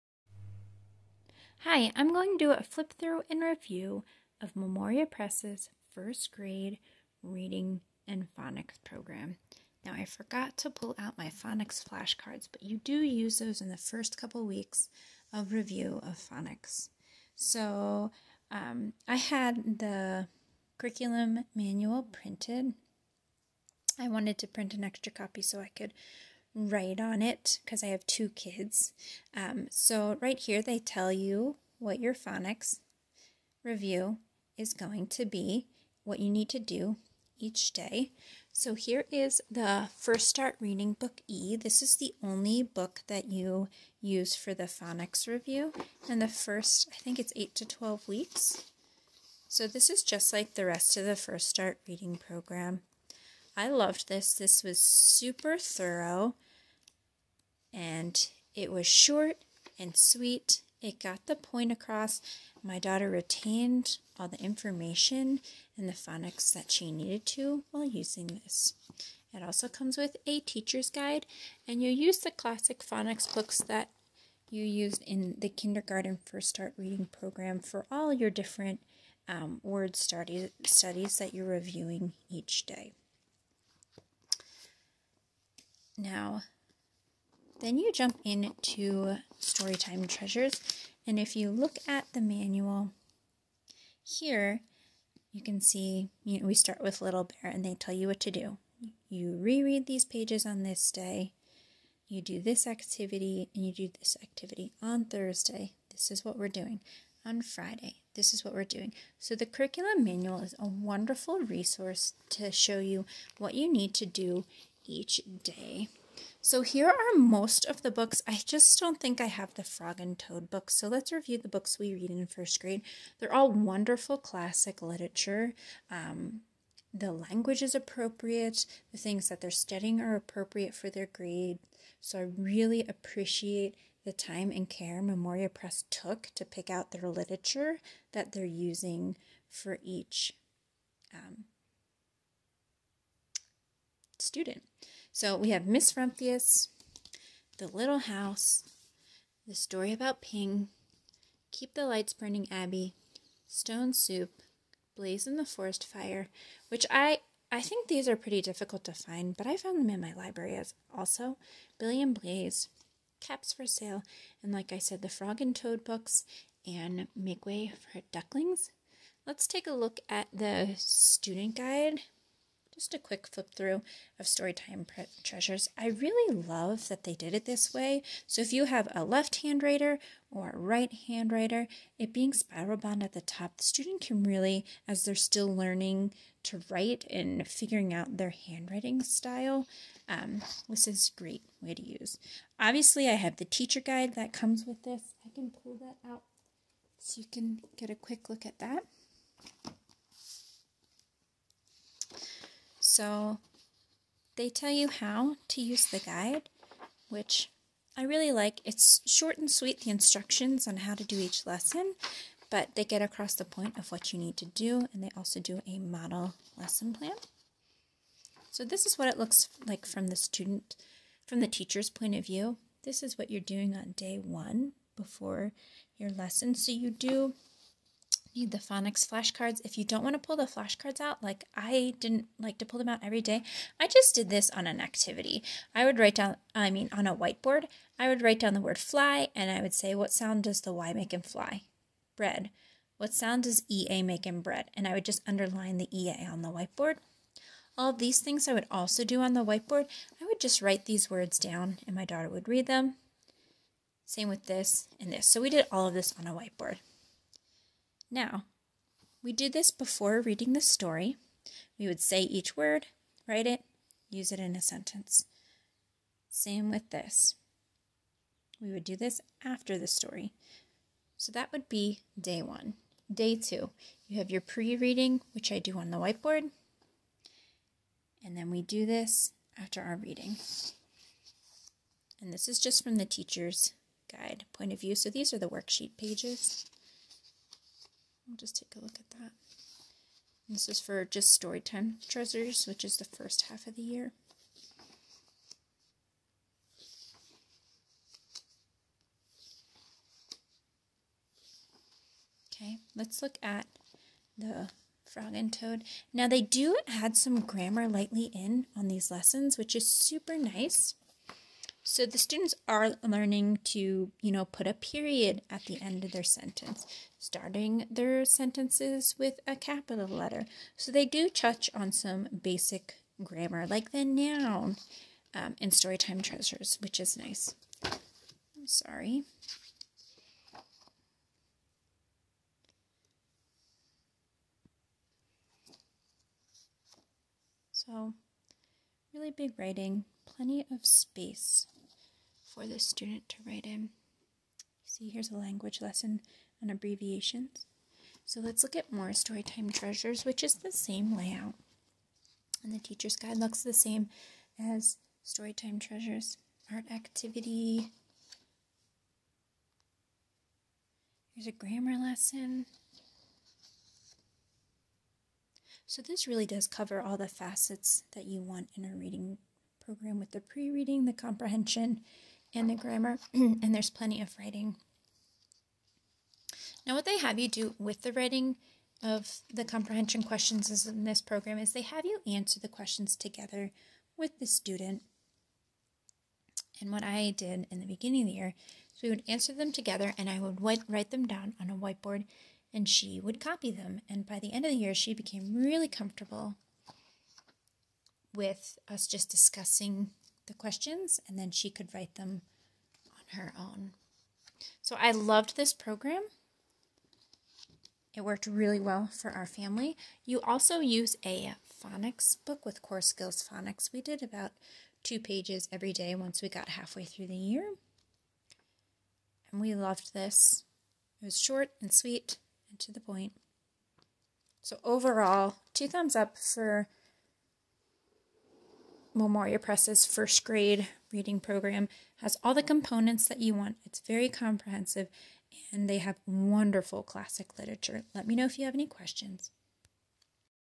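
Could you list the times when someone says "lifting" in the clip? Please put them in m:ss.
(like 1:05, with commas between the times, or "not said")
not said.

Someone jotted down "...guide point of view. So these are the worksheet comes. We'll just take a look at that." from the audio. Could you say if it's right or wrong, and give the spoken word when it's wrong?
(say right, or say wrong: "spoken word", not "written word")
wrong: "pages", not "comes".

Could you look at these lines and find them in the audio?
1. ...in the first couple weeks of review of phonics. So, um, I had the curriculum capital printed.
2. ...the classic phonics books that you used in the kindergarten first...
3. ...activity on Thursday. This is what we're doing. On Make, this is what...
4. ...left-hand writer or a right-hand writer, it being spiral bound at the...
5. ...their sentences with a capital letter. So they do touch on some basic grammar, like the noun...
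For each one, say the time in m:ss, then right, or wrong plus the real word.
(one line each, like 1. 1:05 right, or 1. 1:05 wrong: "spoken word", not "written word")
1. 0:13 wrong: "manual", not "capital"
2. 1:12 right
3. 1:44 wrong: "Friday", not "Make"
4. 2:59 right
5. 5:17 right.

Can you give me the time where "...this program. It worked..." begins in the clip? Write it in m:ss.
6:45.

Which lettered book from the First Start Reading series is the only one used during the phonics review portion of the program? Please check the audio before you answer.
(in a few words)
Book E.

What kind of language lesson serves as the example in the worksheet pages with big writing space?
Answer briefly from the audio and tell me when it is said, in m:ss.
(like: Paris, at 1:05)
abbreviations, at 5:46.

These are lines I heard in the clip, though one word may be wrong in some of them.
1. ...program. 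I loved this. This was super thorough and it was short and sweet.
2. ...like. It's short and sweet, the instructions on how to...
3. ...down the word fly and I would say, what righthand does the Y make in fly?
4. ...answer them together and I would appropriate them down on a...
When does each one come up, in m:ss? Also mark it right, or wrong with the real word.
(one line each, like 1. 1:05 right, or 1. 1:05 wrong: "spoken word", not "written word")
1. 0:52 right
2. 3:28 right
3. 3:58 wrong: "sound", not "righthand"
4. 6:29 wrong: "write", not "appropriate".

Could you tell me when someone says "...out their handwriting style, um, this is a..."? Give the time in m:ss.
3:07.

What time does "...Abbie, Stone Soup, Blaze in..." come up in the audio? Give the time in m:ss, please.
2:32.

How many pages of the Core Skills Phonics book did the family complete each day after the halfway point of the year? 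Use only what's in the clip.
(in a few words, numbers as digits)
2.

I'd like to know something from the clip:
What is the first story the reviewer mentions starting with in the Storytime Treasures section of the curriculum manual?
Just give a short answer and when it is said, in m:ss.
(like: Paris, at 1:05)
Little Bear, at 1:37.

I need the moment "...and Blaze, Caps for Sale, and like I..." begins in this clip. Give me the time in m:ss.
2:42.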